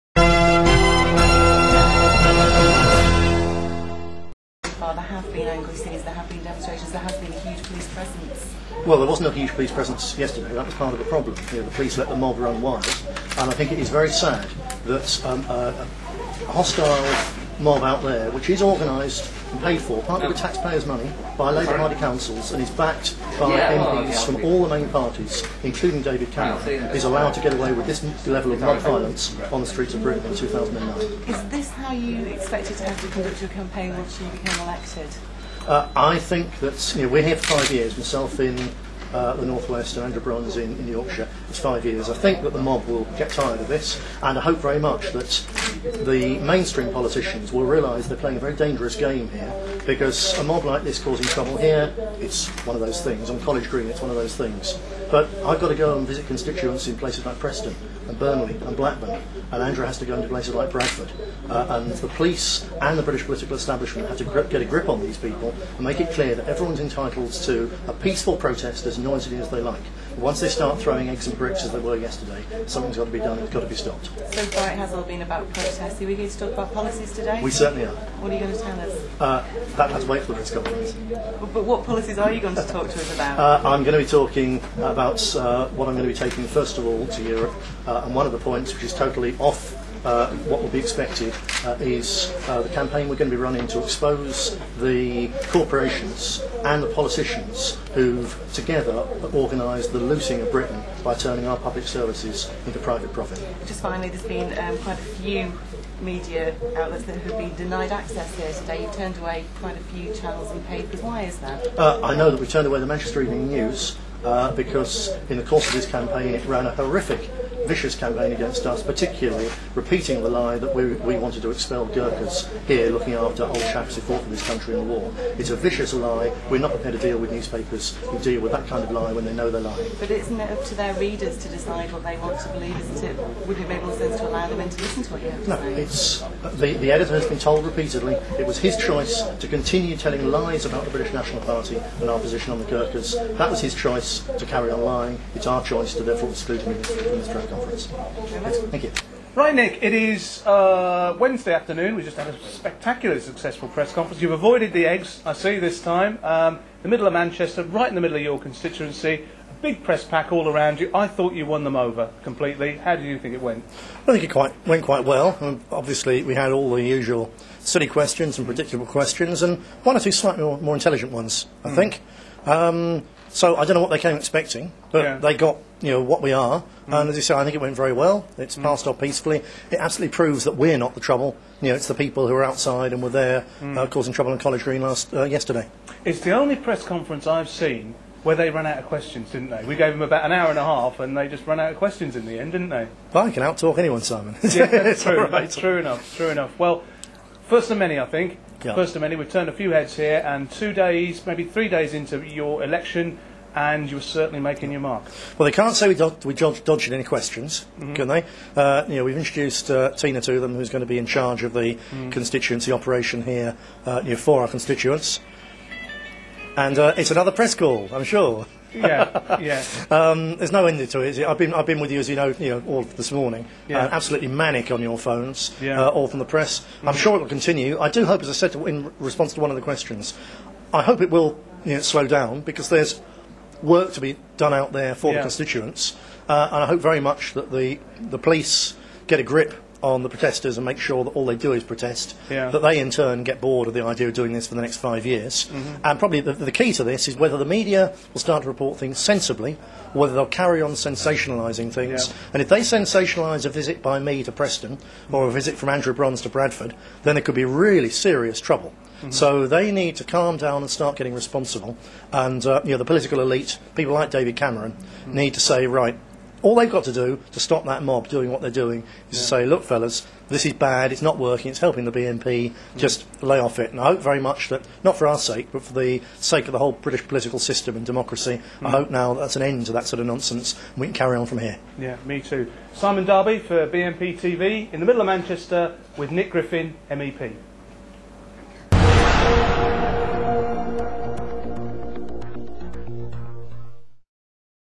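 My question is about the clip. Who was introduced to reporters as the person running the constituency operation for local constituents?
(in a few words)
Tina.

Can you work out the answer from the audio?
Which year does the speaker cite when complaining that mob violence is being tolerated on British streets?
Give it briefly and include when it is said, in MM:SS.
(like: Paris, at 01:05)
2009, at 00:30.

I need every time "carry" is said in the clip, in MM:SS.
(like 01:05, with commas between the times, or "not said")
02:24, 04:10, 04:40.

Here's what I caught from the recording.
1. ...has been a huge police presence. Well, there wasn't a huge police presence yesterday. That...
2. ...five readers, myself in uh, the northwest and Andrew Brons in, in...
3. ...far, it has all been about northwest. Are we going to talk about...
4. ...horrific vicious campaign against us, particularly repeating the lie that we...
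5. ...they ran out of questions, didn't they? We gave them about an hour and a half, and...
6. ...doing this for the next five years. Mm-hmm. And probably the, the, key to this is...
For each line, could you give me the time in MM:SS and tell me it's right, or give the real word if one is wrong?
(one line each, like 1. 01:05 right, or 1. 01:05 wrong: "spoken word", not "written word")
1. 00:07 right
2. 00:37 wrong: "years", not "readers"
3. 01:14 wrong: "protest", not "northwest"
4. 01:56 right
5. 03:08 right
6. 04:04 right.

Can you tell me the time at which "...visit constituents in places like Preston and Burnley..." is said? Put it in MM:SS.
00:56.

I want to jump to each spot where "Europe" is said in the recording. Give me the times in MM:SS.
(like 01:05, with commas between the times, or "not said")
01:27.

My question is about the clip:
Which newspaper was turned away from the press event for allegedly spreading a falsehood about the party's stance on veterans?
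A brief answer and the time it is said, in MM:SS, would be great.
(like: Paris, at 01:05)
Manchester Evening News, at 01:52.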